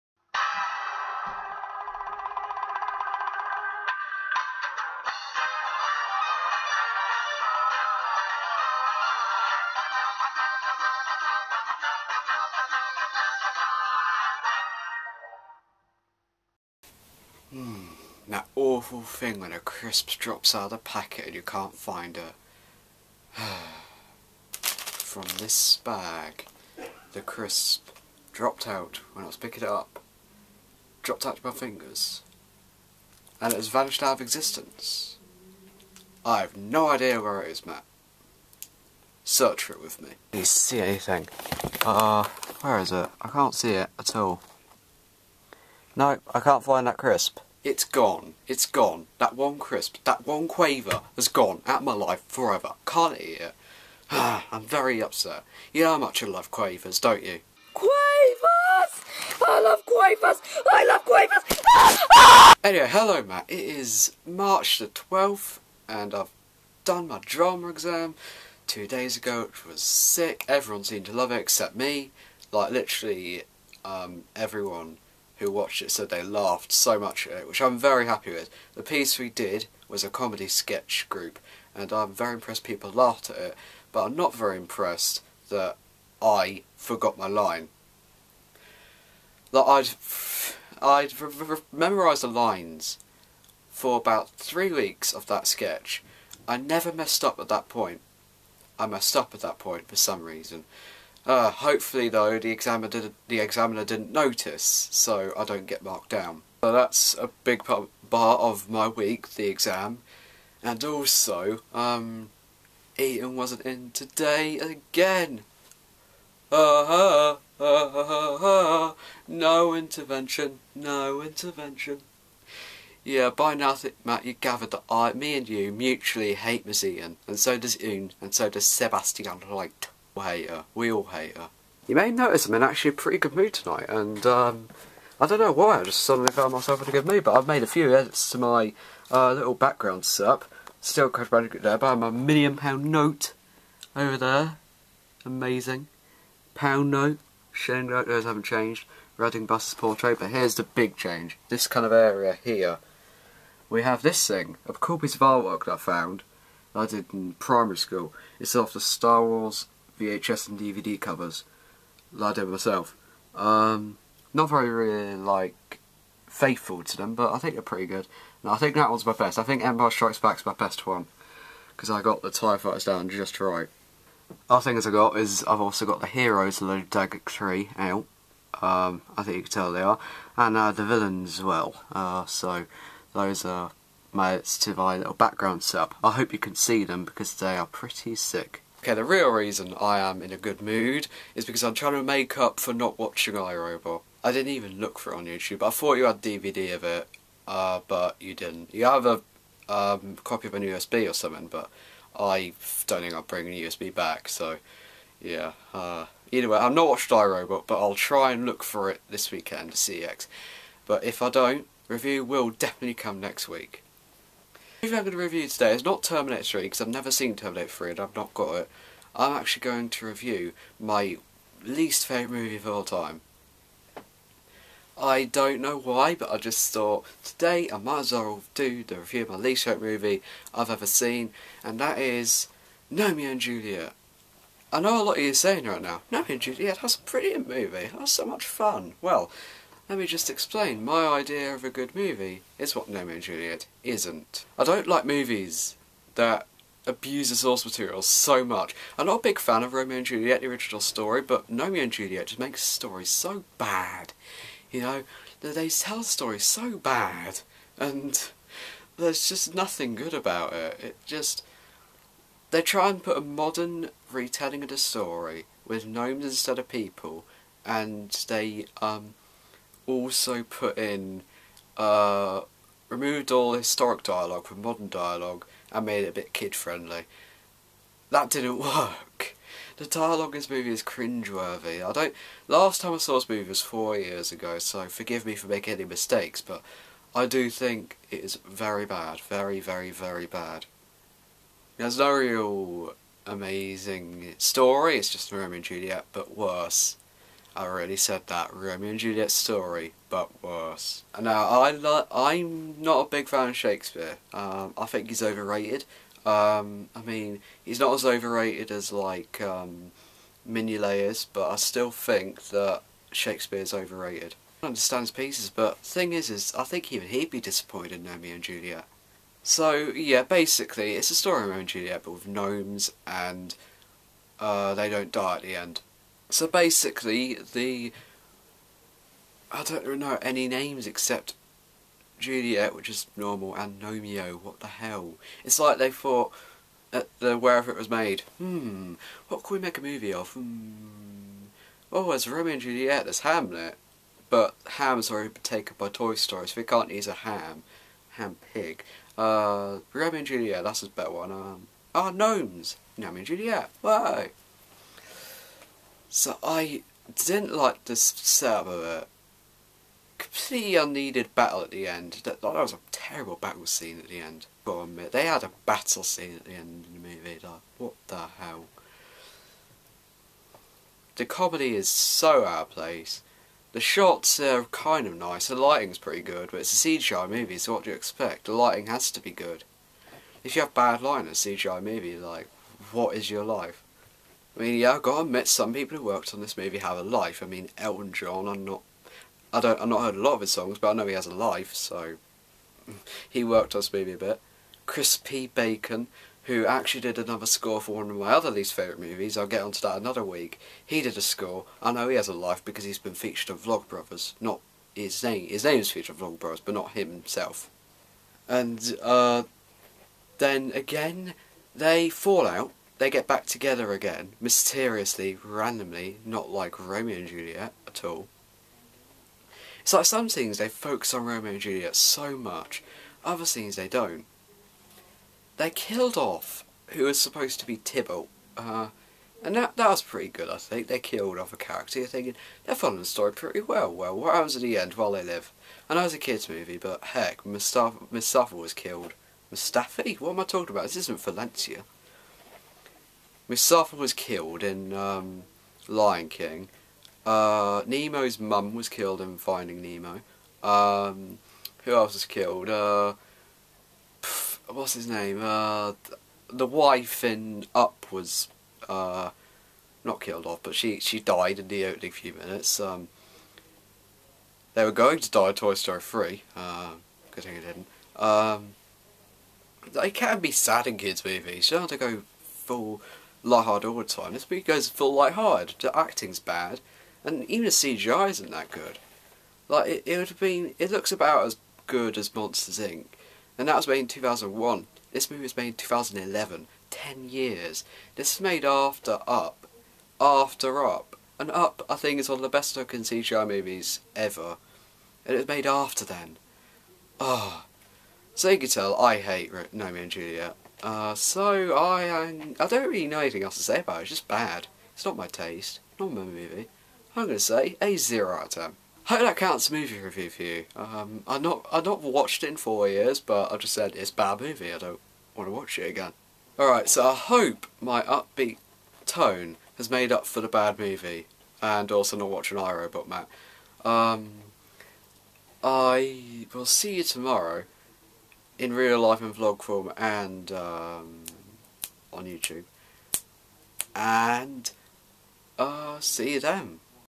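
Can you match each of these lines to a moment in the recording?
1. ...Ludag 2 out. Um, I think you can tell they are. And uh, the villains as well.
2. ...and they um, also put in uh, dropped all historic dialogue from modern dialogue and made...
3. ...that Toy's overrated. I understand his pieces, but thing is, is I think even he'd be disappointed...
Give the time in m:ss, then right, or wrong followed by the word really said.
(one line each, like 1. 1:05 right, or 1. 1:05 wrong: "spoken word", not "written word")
1. 2:56 wrong: "3", not "2"
2. 4:27 wrong: "removed", not "dropped"
3. 5:12 wrong: "Shakespeare", not "Toy".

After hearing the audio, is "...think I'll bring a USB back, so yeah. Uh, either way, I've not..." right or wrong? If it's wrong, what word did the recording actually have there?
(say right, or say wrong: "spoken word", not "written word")
right.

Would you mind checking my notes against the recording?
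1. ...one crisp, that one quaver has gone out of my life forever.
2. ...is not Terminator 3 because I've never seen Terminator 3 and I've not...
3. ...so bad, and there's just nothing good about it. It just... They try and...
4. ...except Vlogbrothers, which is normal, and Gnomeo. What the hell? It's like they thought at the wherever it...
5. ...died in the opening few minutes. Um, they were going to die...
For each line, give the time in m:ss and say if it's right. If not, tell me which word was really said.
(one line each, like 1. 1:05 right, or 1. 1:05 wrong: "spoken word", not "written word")
1. 0:49 right
2. 3:35 right
3. 4:16 right
4. 5:30 wrong: "Juliet", not "Vlogbrothers"
5. 7:41 right.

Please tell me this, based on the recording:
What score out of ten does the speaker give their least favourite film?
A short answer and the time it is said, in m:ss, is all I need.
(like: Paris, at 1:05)
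0, at 8:27.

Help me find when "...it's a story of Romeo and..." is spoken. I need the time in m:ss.
5:20.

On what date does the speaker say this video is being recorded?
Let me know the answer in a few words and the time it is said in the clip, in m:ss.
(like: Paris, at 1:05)
March 12, at 1:04.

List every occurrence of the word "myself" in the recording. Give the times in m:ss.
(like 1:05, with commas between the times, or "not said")
2:16, 2:42.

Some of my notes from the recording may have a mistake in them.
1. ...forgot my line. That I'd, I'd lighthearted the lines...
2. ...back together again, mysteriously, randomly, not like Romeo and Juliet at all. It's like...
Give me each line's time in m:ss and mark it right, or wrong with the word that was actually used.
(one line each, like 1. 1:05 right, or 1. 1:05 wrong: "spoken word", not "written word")
1. 1:26 wrong: "memorised", not "lighthearted"
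2. 6:53 right.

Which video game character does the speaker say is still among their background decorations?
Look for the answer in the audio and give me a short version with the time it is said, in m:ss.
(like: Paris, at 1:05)
Crash Bandicoot, at 2:21.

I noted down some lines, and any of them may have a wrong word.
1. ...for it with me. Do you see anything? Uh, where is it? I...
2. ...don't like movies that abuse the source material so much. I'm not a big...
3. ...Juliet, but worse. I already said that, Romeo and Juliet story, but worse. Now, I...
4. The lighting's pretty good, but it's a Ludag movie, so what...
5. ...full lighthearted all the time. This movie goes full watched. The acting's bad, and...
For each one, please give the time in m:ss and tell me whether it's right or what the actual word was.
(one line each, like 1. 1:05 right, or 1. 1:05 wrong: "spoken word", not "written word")
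1. 0:39 right
2. 4:04 right
3. 4:55 right
4. 6:15 wrong: "CGI", not "Ludag"
5. 7:52 wrong: "lighthearted", not "watched".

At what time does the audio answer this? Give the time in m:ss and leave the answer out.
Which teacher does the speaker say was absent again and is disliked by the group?
2:06.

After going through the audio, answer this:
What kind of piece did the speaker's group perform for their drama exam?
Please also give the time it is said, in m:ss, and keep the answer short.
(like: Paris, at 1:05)
comedy sketch, at 1:20.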